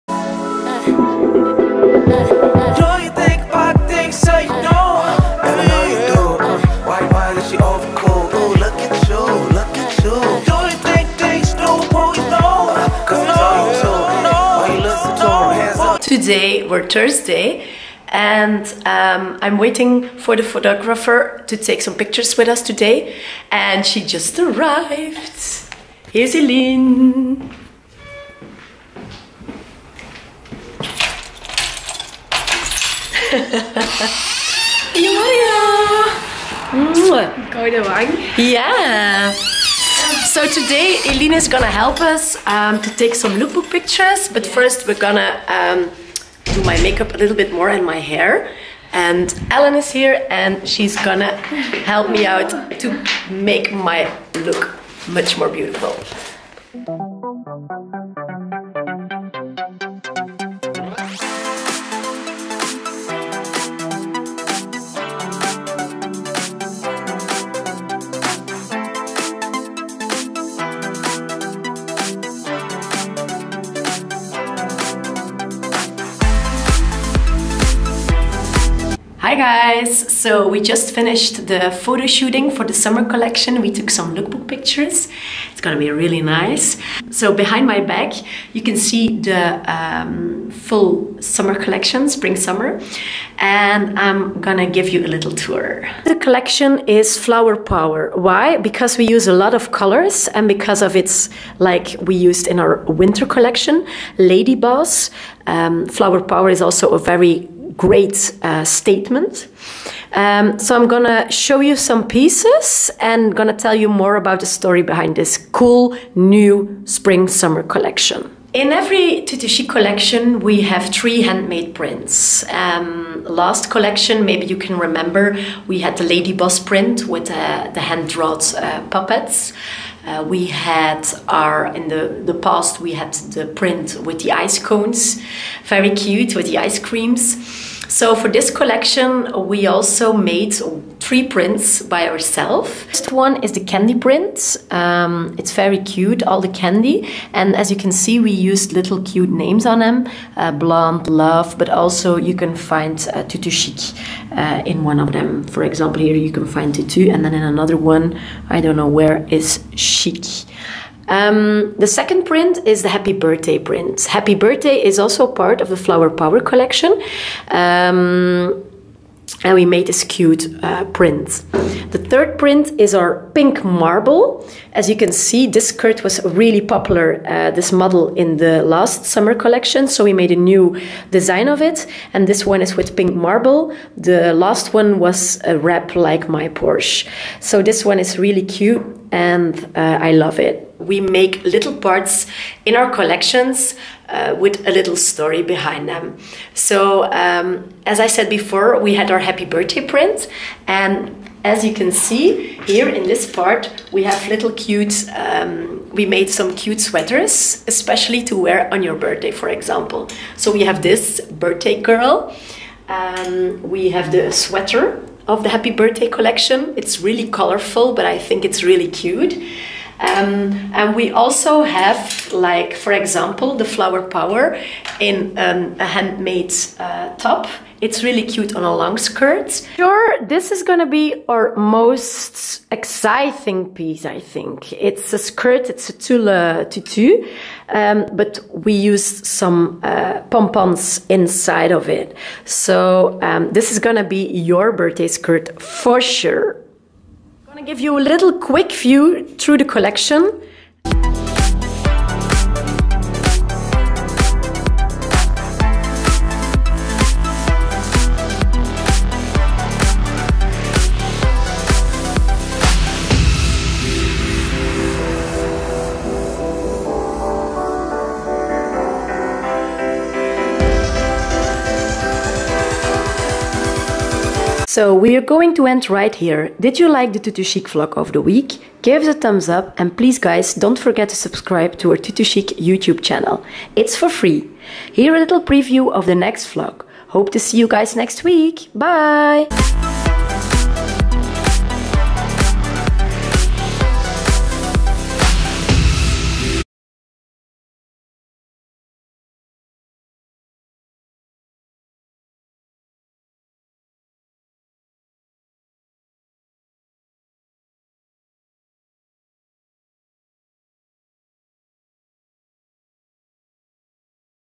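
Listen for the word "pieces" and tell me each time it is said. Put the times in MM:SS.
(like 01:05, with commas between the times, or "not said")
01:52, 03:53.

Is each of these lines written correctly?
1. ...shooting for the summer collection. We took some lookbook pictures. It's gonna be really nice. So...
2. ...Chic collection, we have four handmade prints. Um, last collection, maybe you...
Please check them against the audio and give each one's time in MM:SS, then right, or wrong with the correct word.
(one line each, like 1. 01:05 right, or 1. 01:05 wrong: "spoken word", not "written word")
1. 01:22 right
2. 01:59 wrong: "three", not "four".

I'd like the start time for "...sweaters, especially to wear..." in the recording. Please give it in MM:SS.
03:26.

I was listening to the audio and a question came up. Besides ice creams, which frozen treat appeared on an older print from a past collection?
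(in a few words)
ice cones.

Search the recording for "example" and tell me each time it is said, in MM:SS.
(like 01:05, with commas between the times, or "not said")
02:35, 03:29, 03:42.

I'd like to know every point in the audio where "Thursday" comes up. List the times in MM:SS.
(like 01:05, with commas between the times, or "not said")
00:16.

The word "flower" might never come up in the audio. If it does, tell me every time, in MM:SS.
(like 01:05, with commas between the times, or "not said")
01:37, 01:45, 02:45, 03:43.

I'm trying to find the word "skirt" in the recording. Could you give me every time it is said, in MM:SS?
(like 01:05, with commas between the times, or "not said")
02:55, 03:48, 03:55, 04:05.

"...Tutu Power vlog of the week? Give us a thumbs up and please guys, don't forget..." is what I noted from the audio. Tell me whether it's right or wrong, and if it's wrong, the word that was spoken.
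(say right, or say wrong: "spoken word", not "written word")
wrong: "Chic", not "Power".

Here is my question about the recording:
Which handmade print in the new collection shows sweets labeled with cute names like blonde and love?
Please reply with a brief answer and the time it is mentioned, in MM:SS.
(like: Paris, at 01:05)
candy print, at 02:23.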